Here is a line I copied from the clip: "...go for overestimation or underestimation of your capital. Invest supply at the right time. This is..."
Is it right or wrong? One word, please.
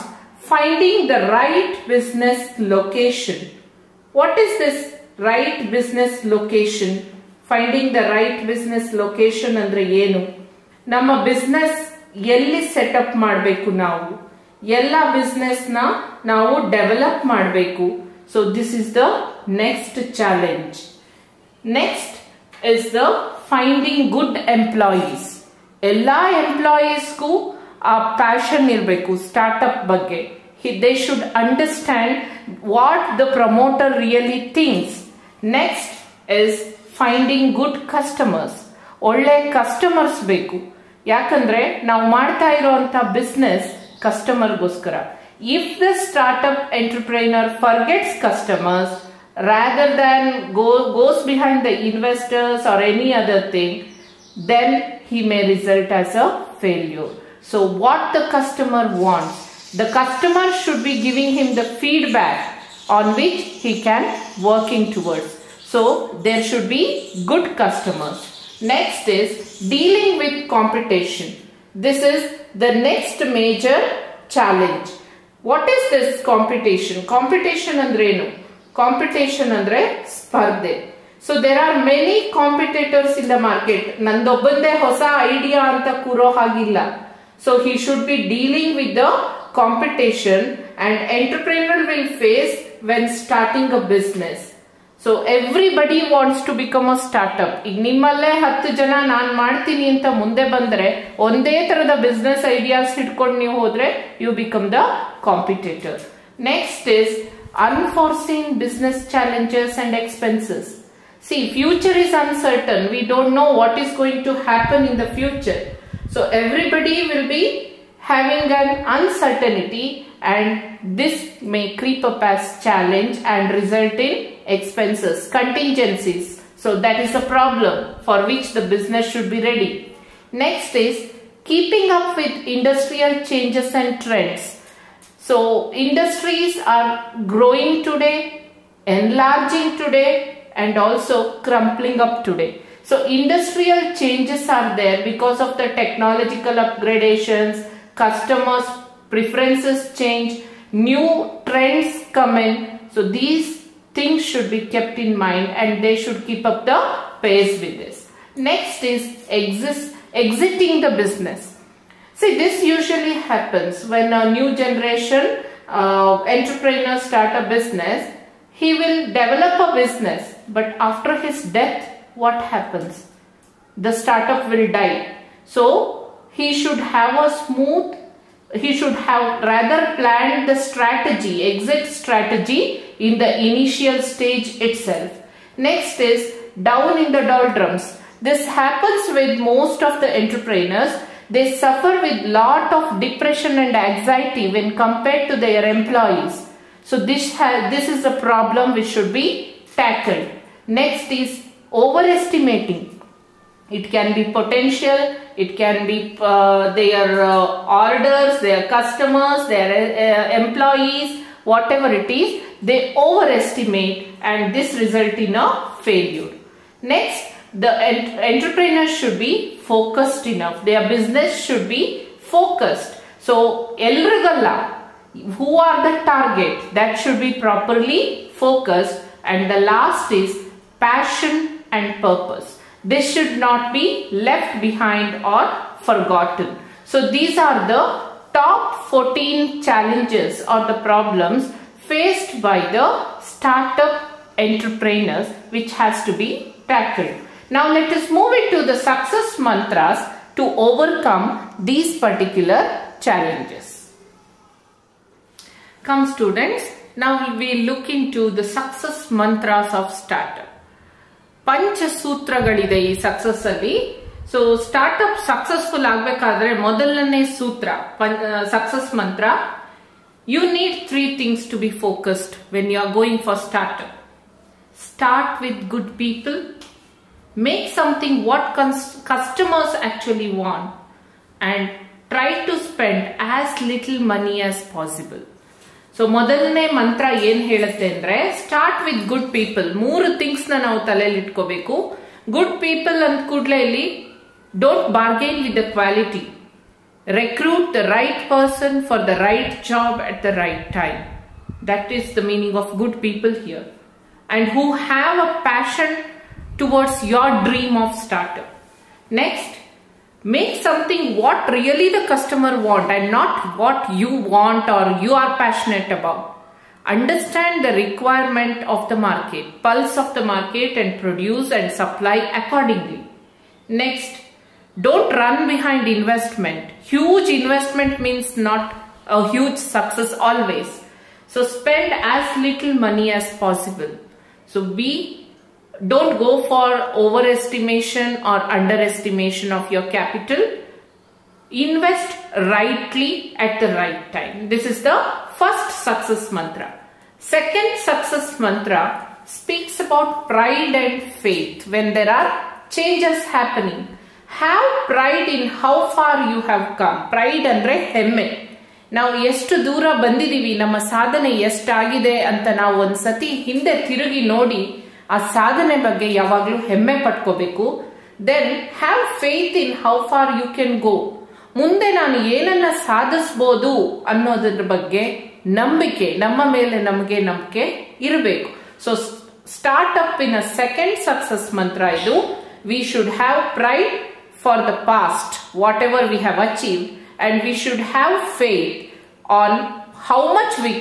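wrong.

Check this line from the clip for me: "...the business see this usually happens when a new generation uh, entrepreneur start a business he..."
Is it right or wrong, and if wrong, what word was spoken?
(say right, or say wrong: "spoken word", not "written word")
right.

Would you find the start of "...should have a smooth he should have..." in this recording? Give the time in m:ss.
2:56.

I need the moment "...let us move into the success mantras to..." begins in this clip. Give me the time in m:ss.
4:07.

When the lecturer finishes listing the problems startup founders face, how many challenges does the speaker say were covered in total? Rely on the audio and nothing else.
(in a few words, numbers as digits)
14.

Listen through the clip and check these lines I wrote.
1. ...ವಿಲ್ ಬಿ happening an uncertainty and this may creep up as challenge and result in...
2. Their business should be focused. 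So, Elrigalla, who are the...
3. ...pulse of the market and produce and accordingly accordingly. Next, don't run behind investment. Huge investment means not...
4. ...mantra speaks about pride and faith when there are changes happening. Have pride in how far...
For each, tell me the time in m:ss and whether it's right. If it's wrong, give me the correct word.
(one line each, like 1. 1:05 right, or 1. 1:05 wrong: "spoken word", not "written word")
1. 1:57 wrong: "having", not "happening"
2. 3:40 right
3. 5:19 wrong: "supply", not "accordingly"
4. 5:48 right.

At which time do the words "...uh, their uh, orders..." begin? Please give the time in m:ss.
3:26.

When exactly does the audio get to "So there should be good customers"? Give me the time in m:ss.
1:05.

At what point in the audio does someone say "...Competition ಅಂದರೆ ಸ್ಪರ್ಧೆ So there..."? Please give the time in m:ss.
1:18.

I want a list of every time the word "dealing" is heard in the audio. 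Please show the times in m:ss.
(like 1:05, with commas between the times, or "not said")
1:09, 1:28.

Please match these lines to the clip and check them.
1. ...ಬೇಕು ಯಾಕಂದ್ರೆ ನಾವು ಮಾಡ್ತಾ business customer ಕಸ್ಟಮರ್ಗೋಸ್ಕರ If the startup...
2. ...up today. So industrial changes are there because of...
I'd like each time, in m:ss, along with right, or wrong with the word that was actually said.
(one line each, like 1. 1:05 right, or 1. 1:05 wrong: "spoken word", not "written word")
1. 0:40 right
2. 2:21 right.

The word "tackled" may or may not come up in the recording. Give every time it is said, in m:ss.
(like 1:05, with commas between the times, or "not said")
3:19, 4:06.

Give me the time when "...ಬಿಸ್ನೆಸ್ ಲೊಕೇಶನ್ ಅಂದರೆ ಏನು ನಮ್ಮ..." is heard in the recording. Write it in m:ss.
0:08.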